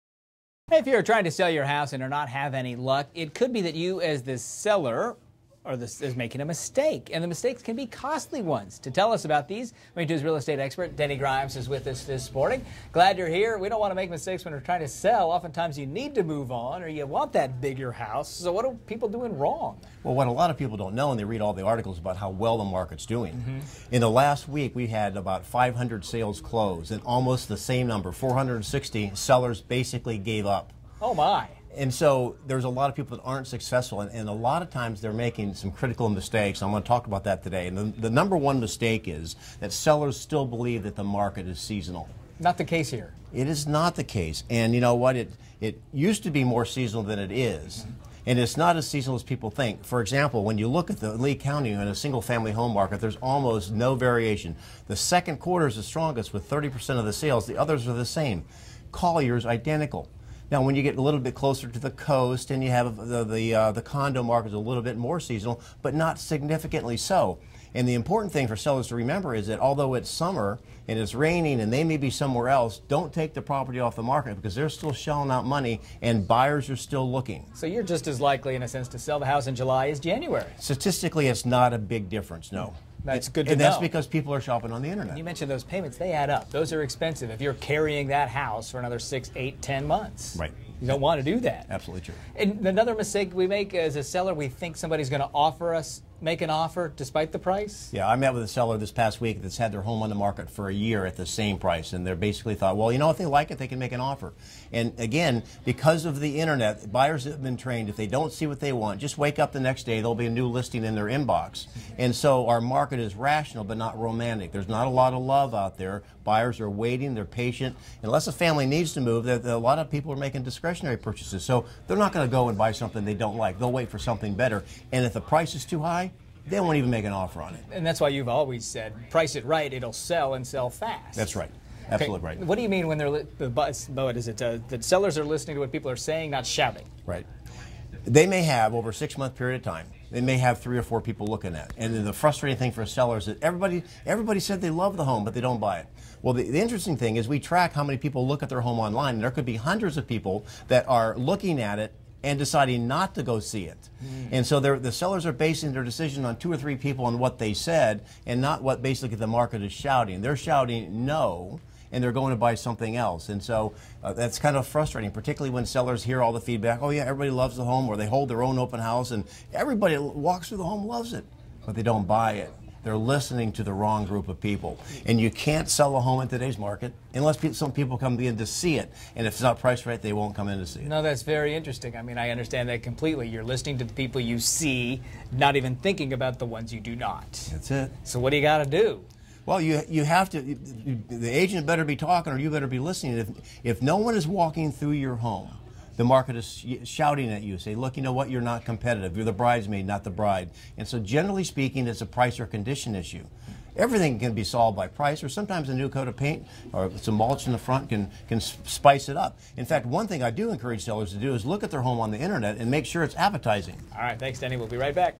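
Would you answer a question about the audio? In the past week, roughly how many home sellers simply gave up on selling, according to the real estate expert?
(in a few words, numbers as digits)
460.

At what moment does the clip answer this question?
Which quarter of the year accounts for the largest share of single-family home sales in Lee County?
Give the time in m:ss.
0:54.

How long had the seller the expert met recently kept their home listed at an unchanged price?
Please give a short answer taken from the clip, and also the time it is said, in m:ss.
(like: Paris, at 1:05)
A year, at 1:40.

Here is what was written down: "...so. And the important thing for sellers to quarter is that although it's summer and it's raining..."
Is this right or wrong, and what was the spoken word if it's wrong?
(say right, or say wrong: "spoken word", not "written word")
wrong: "remember", not "quarter".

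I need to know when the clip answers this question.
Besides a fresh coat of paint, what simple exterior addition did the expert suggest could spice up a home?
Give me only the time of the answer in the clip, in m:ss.
3:27.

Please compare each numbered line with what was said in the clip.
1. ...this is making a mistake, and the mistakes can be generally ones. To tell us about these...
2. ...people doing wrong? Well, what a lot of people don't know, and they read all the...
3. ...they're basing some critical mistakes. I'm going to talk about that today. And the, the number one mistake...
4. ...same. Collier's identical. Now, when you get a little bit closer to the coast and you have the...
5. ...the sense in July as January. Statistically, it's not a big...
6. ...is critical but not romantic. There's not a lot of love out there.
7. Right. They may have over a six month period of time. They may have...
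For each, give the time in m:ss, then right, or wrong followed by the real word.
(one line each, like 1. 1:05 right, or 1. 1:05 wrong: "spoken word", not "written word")
1. 0:05 wrong: "costly", not "generally"
2. 0:18 right
3. 0:34 wrong: "making", not "basing"
4. 0:58 right
5. 1:19 wrong: "house", not "sense"
6. 1:52 wrong: "rational", not "critical"
7. 2:17 right.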